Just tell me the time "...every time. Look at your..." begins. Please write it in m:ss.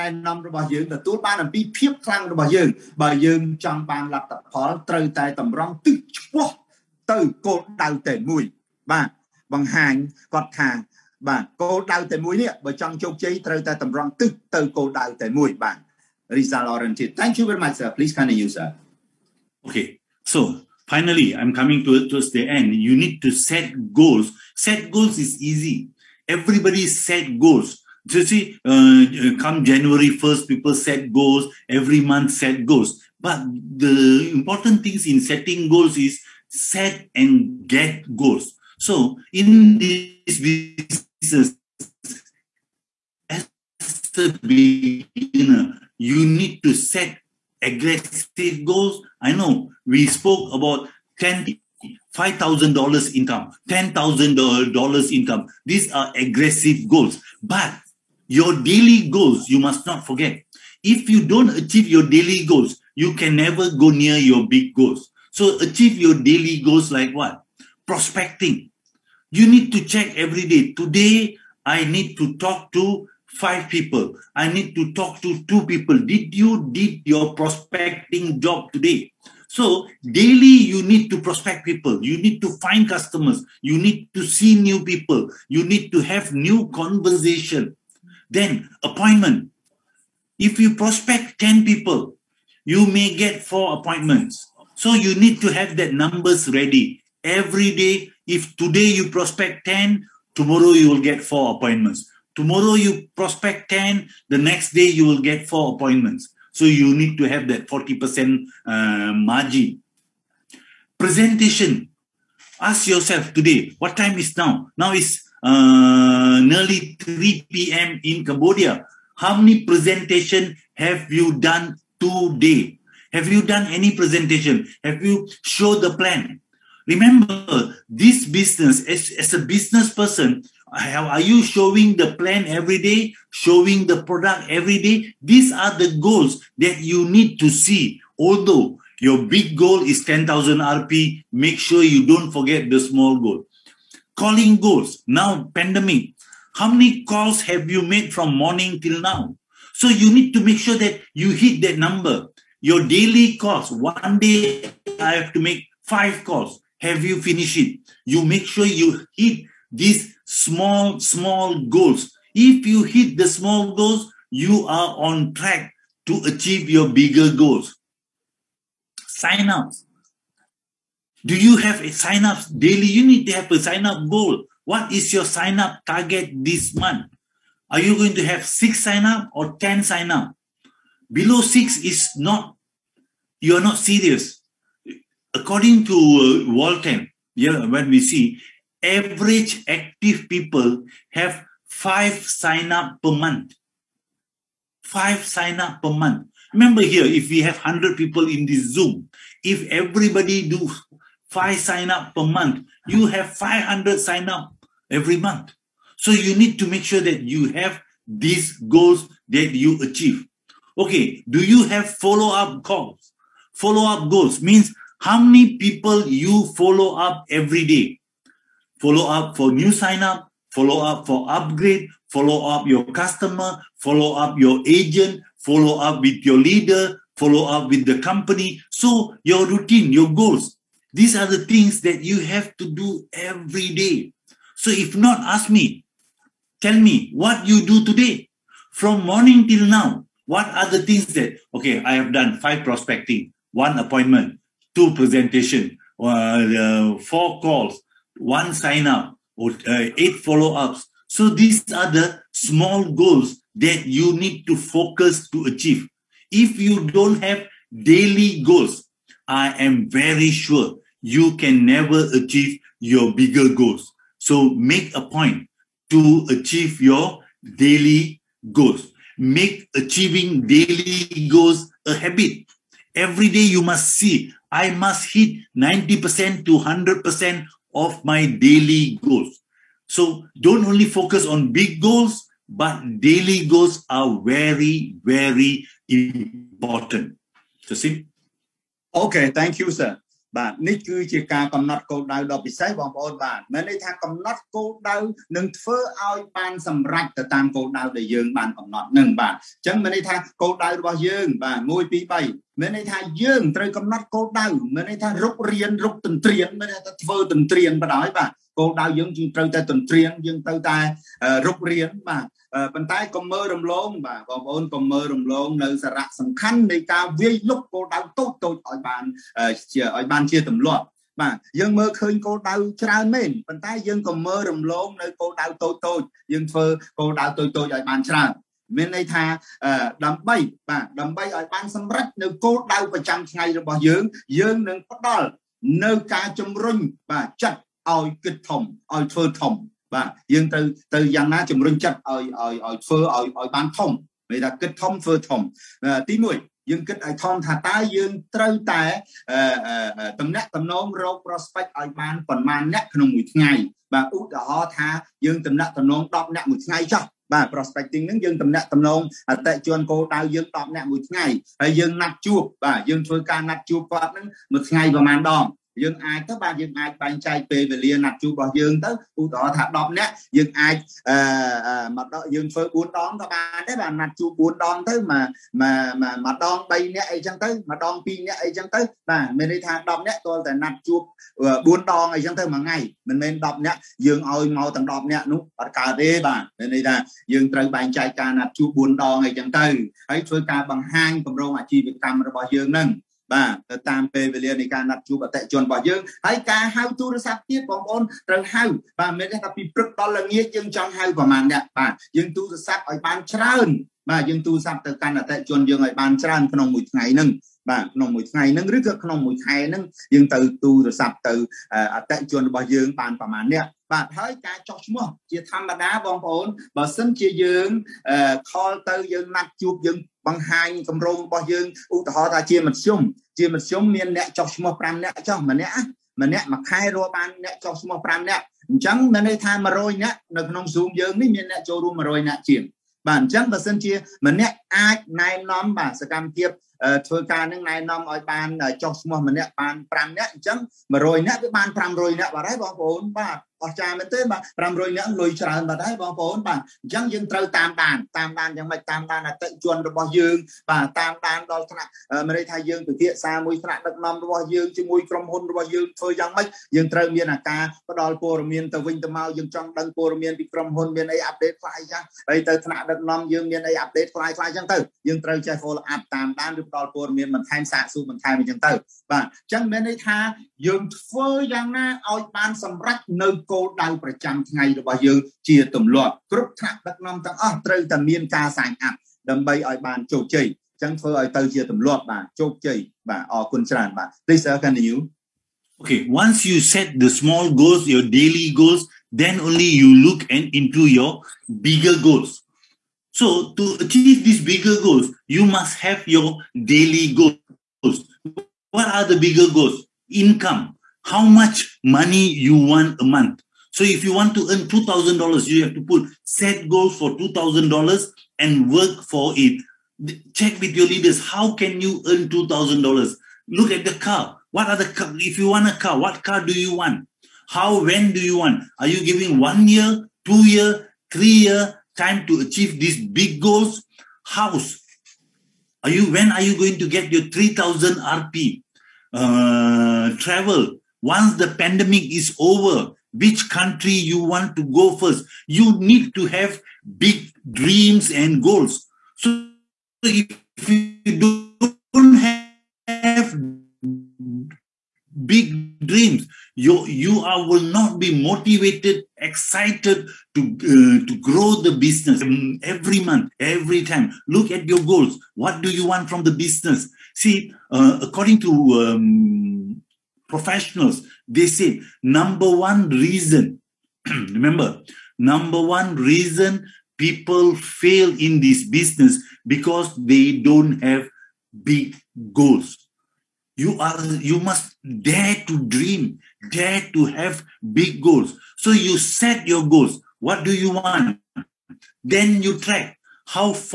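9:13.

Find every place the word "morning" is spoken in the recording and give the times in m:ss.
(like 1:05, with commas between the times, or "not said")
2:28, 3:59.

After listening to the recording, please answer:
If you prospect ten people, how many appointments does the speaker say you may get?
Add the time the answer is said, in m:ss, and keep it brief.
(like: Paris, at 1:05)
4, at 1:32.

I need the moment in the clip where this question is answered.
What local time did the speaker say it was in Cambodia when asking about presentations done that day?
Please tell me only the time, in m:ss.
1:56.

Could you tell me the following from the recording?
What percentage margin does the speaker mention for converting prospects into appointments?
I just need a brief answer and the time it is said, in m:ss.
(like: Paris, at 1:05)
40%, at 1:47.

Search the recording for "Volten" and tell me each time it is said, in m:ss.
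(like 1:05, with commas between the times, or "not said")
3:06.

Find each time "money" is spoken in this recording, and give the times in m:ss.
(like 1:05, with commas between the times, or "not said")
8:21.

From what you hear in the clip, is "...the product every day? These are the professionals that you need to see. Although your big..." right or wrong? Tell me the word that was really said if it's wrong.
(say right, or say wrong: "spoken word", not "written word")
wrong: "goals", not "professionals".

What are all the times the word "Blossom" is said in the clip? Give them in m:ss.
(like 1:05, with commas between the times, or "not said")
not said.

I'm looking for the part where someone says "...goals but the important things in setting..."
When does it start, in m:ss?
0:32.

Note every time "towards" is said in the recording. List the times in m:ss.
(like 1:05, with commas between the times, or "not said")
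0:22.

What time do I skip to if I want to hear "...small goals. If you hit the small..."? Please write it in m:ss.
2:40.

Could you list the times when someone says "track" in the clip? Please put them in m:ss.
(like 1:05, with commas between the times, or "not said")
2:45, 9:42.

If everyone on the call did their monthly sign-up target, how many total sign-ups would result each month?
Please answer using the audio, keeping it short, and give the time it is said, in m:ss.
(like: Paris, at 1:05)
500, at 3:23.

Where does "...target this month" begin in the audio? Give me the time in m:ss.
2:55.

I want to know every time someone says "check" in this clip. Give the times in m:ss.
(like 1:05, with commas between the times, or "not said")
1:09, 8:30.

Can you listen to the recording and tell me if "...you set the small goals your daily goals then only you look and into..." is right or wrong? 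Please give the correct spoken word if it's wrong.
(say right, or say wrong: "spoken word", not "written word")
right.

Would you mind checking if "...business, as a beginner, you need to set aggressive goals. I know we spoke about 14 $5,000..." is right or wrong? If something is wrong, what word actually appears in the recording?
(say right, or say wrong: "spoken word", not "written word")
wrong: "10", not "14".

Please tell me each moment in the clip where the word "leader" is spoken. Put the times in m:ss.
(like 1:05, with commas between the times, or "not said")
3:46, 8:30.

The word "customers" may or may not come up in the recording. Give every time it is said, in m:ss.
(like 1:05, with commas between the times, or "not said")
1:22, 3:42.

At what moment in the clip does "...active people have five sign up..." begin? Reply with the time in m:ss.
3:09.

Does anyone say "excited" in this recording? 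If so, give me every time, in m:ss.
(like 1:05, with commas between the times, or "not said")
9:09.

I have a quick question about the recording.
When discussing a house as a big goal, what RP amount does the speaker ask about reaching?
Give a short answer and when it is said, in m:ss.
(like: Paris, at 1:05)
3000 RP, at 8:47.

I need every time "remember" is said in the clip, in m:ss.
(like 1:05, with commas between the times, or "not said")
2:06, 3:16, 9:24.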